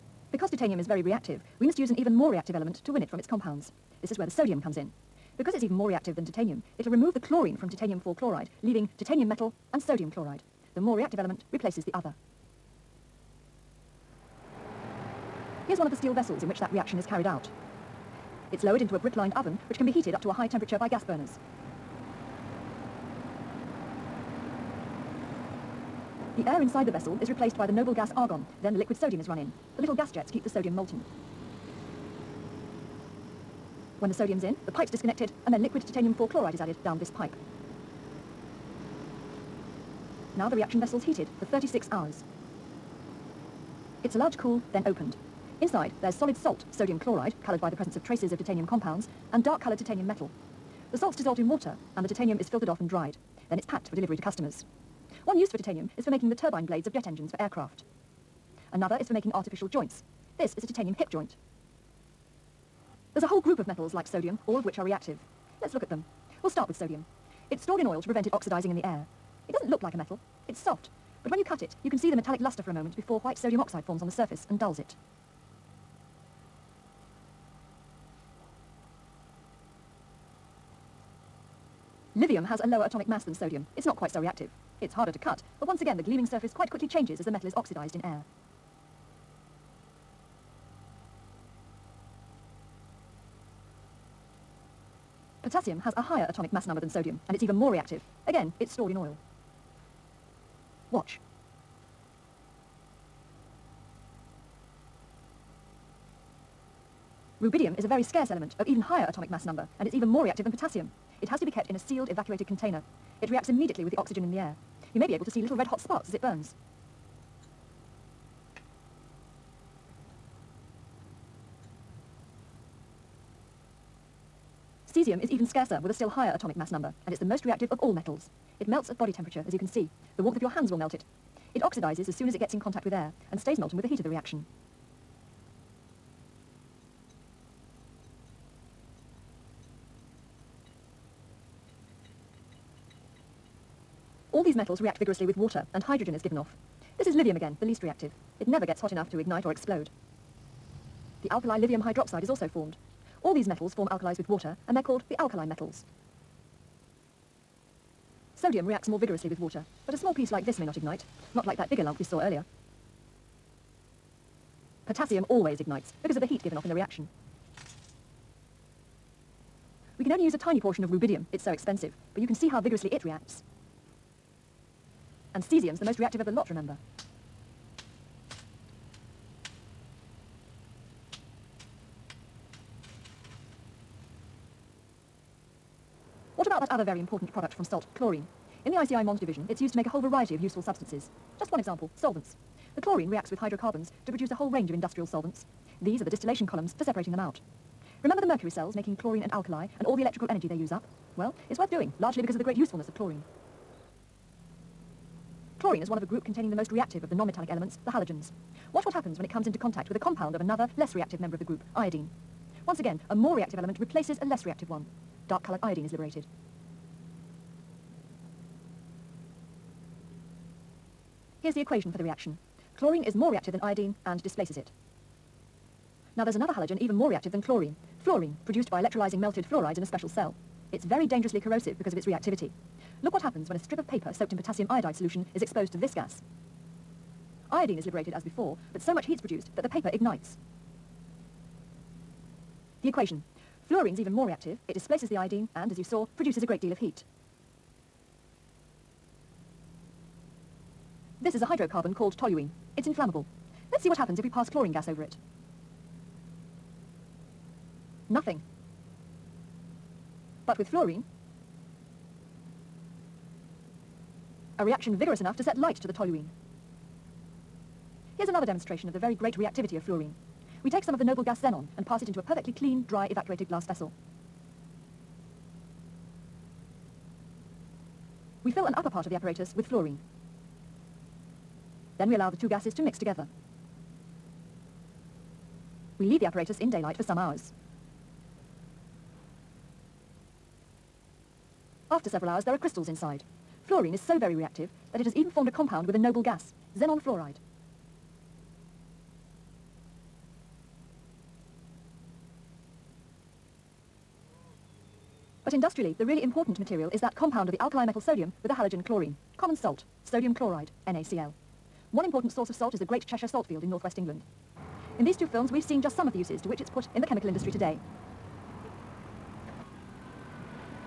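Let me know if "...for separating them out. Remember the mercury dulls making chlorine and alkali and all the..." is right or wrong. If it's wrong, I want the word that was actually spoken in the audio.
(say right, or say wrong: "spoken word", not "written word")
wrong: "cells", not "dulls".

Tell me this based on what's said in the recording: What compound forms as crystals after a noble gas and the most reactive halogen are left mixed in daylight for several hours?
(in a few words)
xenon fluoride.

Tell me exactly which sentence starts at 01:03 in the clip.
There's a whole group of metals like sodium, all of which are reactive.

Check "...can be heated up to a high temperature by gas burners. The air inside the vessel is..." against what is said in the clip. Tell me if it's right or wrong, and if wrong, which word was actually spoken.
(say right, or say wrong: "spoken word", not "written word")
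right.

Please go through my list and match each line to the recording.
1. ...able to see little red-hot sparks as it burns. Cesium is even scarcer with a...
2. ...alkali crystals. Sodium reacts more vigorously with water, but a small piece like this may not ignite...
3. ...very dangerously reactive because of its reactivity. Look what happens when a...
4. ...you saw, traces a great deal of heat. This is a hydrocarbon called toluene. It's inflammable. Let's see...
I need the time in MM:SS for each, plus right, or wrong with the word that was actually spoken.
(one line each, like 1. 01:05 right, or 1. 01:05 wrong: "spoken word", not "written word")
1. 01:55 right
2. 02:35 wrong: "metals", not "crystals"
3. 03:50 wrong: "corrosive", not "reactive"
4. 04:05 wrong: "produces", not "traces".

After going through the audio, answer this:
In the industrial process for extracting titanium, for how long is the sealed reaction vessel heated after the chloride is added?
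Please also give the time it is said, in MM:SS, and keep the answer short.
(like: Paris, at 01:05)
36 hours, at 00:41.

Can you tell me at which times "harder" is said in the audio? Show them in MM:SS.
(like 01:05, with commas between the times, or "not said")
01:24.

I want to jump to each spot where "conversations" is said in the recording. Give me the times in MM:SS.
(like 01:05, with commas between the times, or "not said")
not said.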